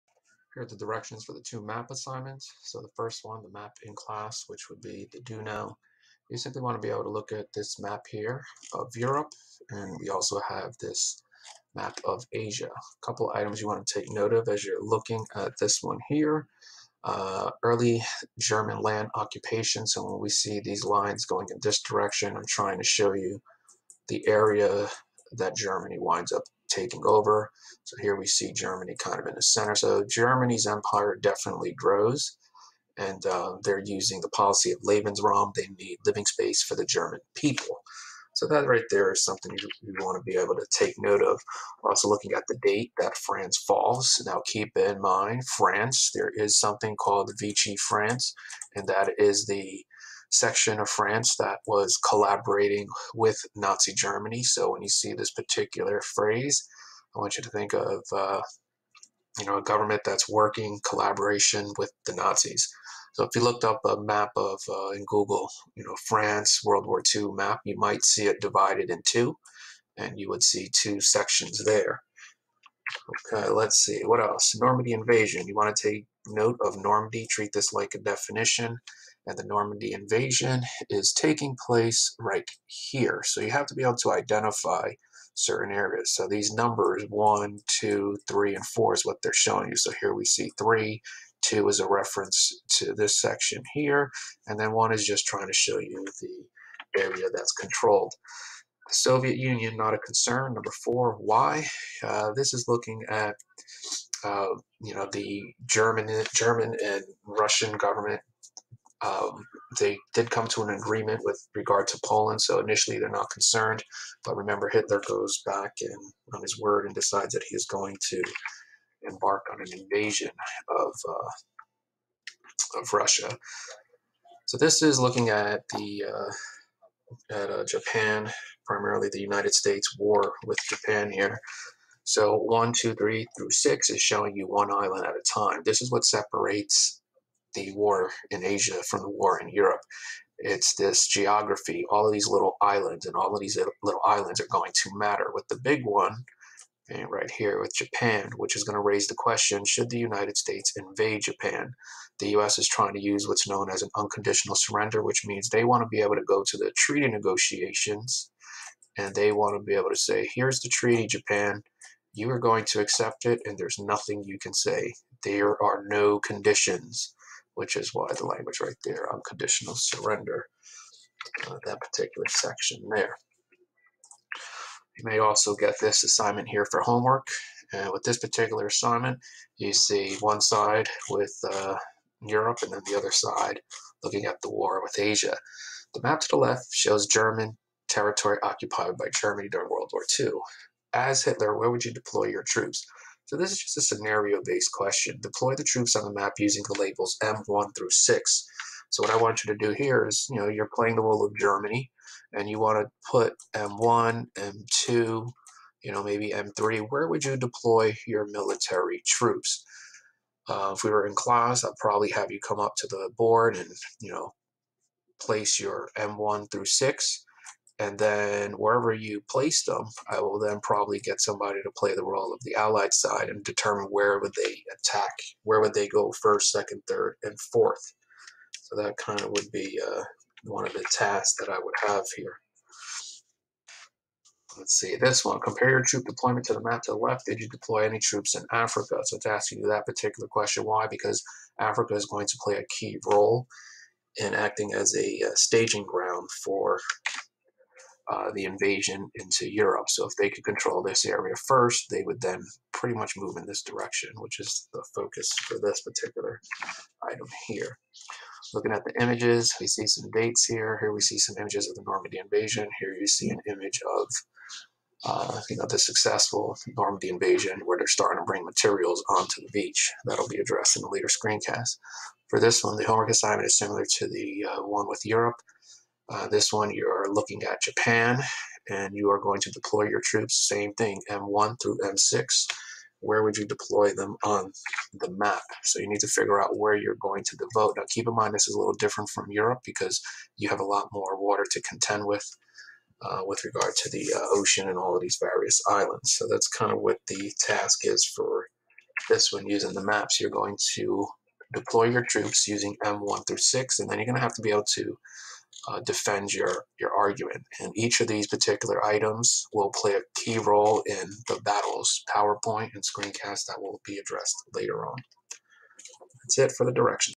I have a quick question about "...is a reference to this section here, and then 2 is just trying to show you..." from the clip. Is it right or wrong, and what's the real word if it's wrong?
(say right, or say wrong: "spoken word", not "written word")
wrong: "1", not "2".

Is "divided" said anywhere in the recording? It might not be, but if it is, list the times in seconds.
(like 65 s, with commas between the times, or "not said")
68 s.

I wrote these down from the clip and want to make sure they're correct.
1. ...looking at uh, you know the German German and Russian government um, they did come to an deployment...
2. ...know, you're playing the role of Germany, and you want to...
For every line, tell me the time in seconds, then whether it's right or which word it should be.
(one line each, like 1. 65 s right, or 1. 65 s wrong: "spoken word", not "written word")
1. 102 s wrong: "agreement", not "deployment"
2. 200 s right.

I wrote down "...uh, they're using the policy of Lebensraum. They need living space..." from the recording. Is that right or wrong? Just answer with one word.
right.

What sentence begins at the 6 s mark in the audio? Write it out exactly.
You simply want to be able to look at this map here of Europe, and we also have this map of Asia.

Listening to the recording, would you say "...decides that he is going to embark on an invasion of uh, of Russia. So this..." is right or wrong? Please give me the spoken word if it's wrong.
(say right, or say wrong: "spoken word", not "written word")
right.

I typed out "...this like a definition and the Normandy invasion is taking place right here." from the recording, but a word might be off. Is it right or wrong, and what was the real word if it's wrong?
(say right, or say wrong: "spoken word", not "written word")
right.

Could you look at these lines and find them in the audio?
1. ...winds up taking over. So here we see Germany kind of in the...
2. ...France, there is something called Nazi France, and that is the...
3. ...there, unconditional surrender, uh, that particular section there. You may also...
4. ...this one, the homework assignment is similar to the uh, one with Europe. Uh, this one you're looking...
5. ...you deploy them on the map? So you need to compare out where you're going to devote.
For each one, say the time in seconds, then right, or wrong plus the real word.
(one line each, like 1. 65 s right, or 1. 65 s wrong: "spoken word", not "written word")
1. 25 s right
2. 45 s wrong: "Vichy", not "Nazi"
3. 168 s right
4. 272 s right
5. 283 s wrong: "figure", not "compare".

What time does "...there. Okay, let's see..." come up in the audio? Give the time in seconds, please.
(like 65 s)
71 s.